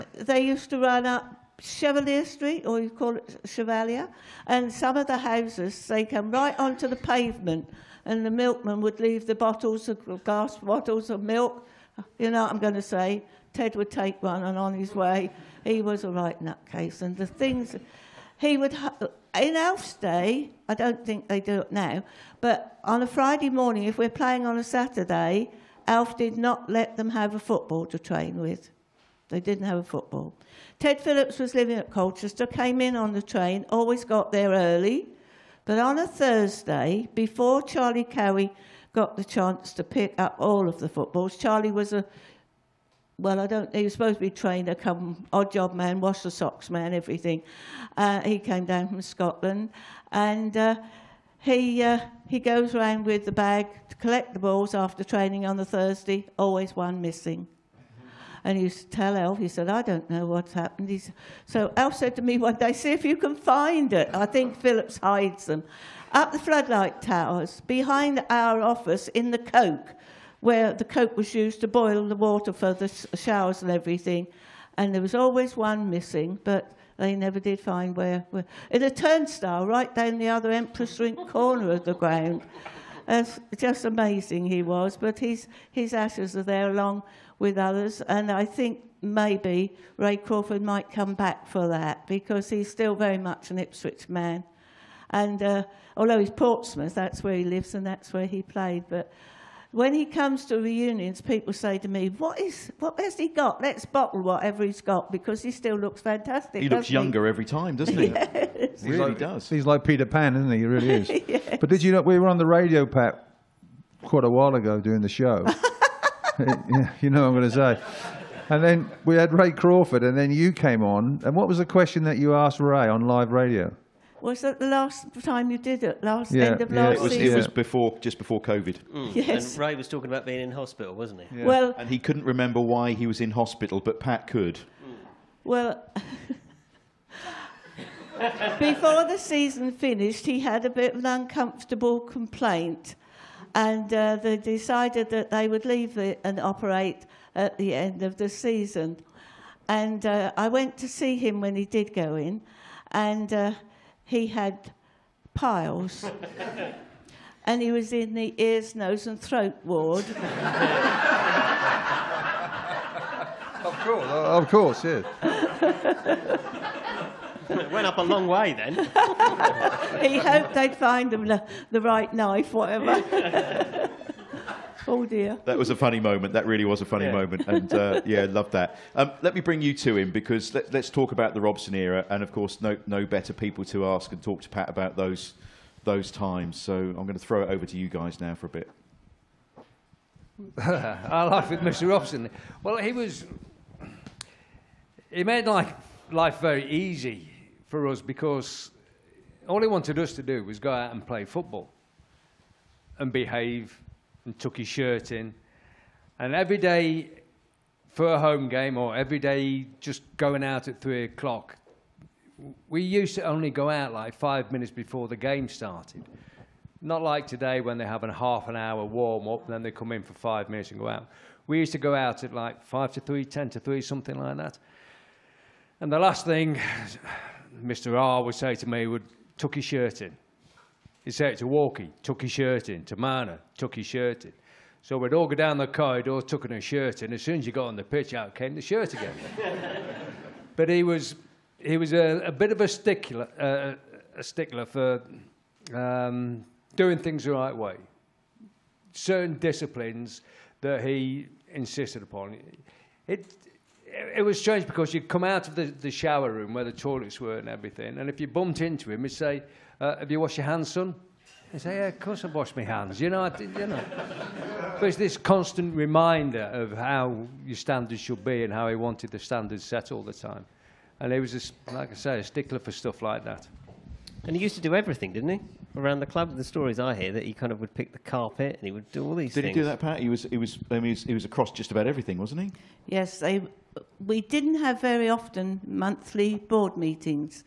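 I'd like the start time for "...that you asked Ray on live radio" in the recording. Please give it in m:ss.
2:02.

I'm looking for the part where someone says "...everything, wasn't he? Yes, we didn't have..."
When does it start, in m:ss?
4:41.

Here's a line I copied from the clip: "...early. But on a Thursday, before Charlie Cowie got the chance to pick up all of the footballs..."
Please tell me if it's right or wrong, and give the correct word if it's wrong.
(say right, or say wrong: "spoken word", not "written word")
right.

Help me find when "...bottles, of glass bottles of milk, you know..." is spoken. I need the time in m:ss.
0:09.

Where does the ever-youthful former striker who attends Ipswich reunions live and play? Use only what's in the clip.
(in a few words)
Portsmouth.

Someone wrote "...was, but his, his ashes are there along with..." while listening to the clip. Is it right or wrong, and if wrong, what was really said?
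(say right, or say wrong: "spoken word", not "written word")
right.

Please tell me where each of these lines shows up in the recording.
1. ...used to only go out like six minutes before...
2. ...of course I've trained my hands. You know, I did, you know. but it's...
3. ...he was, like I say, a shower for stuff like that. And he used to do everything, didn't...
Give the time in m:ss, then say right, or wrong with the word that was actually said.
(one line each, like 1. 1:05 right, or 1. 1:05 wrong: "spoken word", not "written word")
1. 3:32 wrong: "five", not "six"
2. 4:21 wrong: "washed", not "trained"
3. 4:31 wrong: "stickler", not "shower".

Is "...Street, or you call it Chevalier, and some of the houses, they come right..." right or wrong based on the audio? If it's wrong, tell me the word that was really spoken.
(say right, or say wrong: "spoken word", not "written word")
right.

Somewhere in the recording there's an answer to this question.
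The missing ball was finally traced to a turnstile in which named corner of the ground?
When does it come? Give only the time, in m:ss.
1:20.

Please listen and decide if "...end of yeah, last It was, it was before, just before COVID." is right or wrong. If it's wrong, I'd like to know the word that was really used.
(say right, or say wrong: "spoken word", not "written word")
right.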